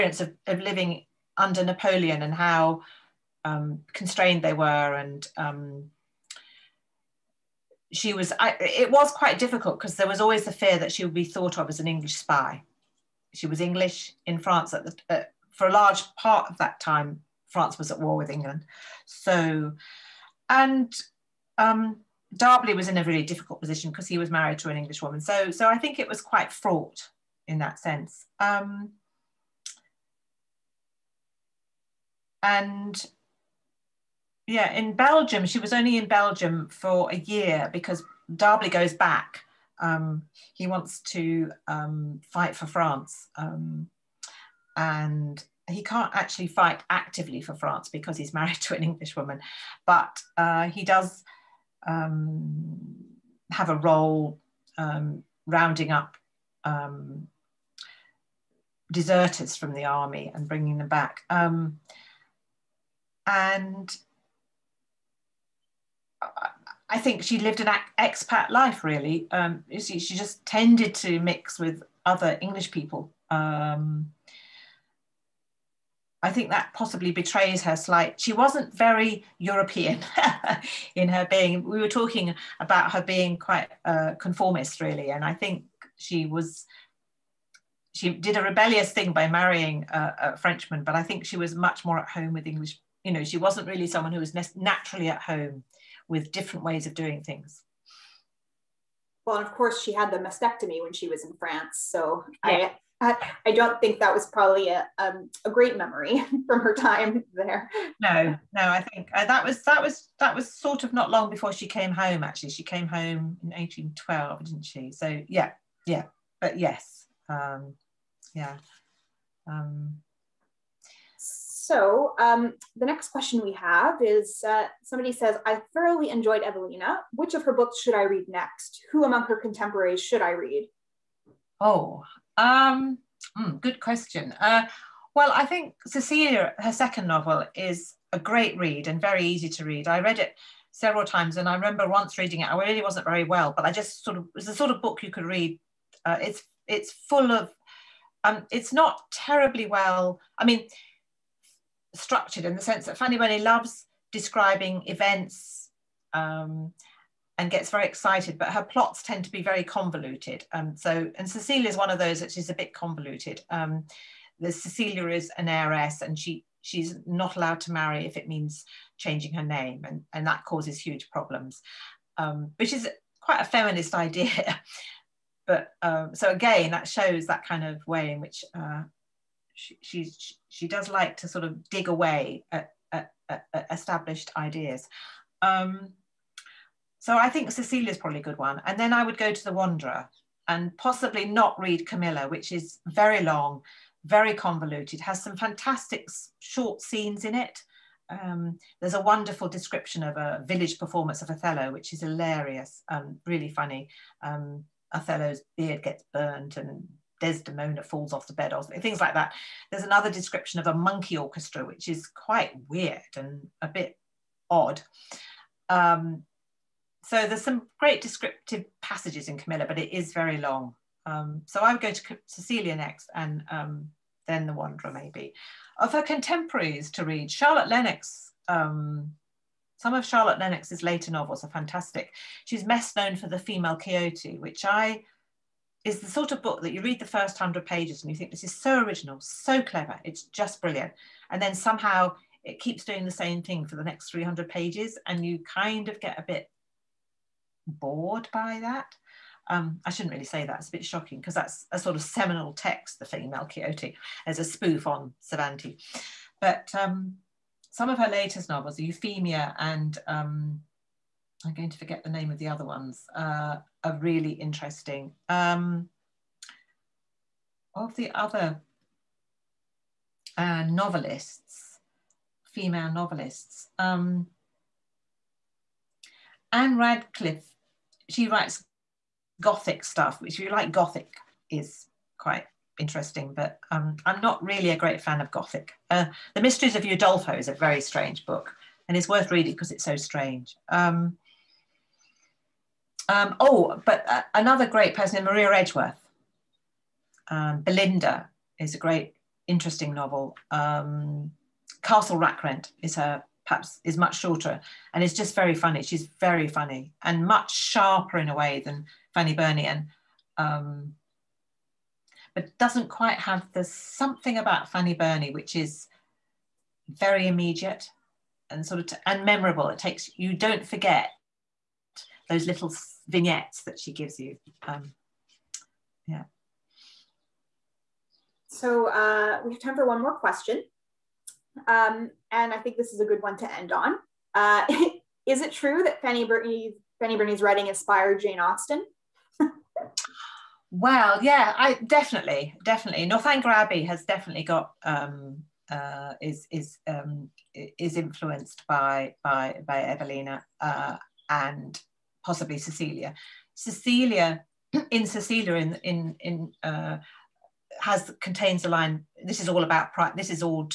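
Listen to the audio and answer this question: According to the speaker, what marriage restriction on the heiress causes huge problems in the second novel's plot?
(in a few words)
Changing her name.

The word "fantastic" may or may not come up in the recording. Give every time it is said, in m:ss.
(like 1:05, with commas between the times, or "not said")
3:15, 3:51.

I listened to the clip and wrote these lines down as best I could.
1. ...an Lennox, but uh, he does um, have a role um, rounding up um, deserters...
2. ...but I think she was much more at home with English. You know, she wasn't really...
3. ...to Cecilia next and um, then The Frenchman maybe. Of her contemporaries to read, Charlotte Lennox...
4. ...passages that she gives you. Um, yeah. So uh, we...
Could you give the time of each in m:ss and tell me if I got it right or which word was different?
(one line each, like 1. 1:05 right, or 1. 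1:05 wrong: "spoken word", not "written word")
1. 0:48 wrong: "Englishwoman", not "Lennox"
2. 1:30 right
3. 3:41 wrong: "Wanderer", not "Frenchman"
4. 5:23 wrong: "vignettes", not "passages".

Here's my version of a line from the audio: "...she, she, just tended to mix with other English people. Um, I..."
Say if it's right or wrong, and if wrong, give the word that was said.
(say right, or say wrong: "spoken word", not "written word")
right.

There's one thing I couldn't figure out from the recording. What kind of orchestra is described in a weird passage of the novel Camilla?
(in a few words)
A monkey orchestra.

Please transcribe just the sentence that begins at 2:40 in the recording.
Um, so, and Cecilia is one of those that is a bit convoluted.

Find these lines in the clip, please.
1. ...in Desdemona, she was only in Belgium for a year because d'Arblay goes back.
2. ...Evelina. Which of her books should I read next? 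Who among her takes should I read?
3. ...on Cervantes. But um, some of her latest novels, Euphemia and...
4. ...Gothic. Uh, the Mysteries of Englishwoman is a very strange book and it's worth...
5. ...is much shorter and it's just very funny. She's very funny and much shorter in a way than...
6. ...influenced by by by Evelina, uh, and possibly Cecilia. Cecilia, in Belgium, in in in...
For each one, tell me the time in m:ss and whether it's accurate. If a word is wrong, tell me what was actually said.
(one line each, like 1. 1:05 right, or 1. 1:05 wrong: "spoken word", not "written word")
1. 0:34 wrong: "Belgium", not "Desdemona"
2. 2:06 wrong: "contemporaries", not "takes"
3. 4:14 right
4. 4:45 wrong: "Udolpho", not "Englishwoman"
5. 5:03 wrong: "sharper", not "shorter"
6. 5:47 wrong: "Cecilia", not "Belgium".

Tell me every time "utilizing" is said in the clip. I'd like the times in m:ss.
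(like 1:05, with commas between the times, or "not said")
not said.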